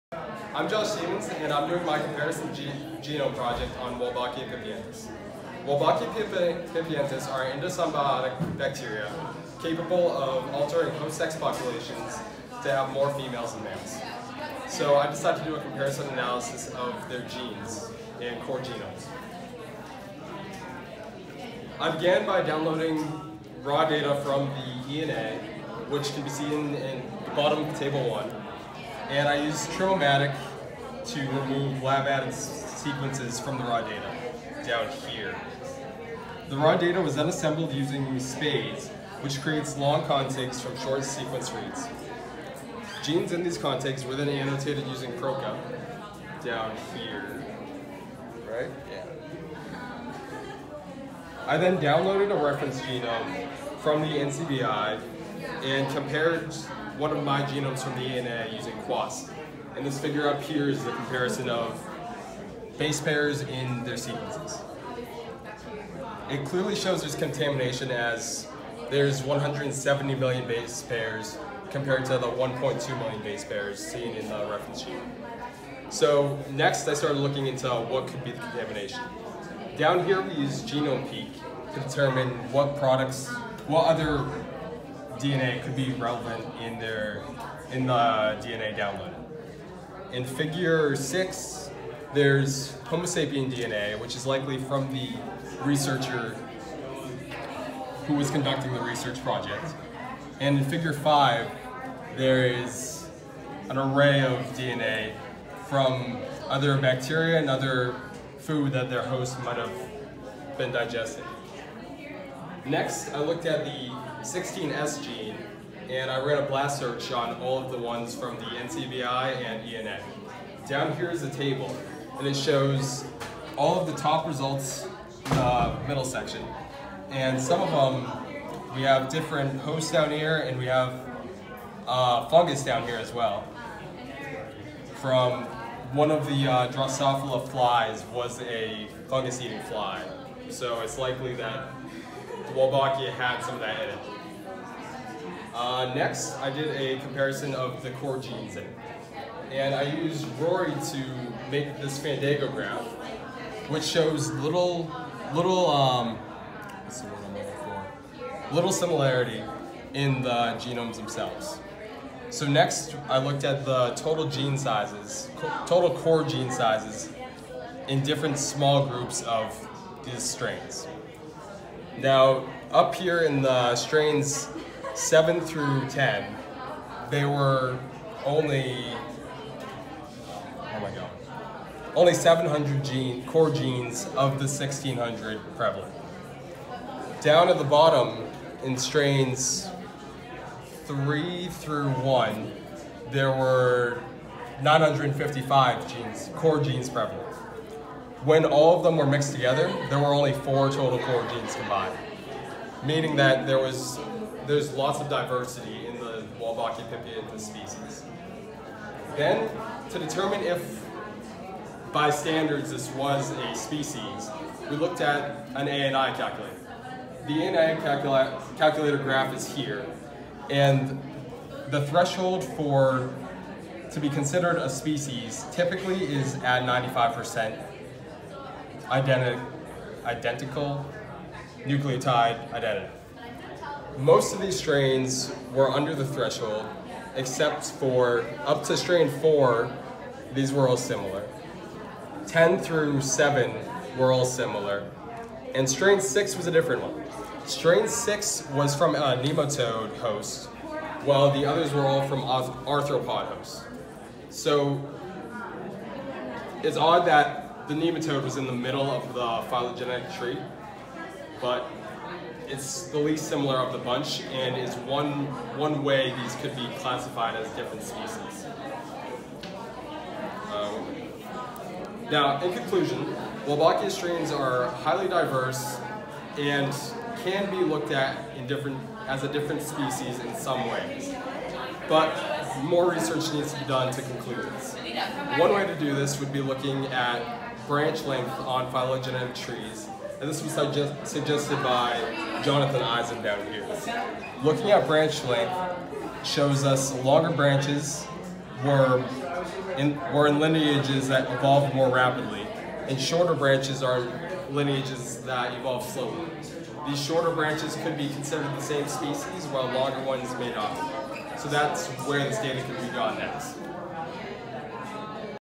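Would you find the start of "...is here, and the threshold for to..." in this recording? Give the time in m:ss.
3:39.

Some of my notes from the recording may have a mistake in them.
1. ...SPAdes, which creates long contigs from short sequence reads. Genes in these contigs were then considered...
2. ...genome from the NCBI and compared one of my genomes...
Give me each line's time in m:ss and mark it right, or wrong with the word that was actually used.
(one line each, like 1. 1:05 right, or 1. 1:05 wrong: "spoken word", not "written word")
1. 0:38 wrong: "annotated", not "considered"
2. 0:52 right.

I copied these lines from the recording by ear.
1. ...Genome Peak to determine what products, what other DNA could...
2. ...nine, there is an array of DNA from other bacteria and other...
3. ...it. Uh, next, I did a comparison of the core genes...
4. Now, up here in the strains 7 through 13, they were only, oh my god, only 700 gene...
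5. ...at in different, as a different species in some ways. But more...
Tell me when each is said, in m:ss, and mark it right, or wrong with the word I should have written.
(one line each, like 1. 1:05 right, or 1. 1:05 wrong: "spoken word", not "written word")
1. 1:20 right
2. 1:40 wrong: "five", not "nine"
3. 2:23 right
4. 2:51 wrong: "10", not "13"
5. 4:37 right.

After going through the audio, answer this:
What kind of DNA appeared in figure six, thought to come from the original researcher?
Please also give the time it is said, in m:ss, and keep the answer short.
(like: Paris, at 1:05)
Homo sapien, at 1:32.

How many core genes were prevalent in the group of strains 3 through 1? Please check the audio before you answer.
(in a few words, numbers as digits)
955.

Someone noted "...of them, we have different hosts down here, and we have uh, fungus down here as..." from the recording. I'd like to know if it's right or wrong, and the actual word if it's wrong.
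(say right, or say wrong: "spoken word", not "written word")
right.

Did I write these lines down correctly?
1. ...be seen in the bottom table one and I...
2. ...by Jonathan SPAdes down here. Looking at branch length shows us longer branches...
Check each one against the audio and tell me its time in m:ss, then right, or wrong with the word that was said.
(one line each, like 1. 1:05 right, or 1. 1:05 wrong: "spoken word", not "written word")
1. 0:26 right
2. 4:51 wrong: "Eisen", not "SPAdes".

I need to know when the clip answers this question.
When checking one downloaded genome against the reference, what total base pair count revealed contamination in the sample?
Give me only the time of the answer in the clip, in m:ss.
1:09.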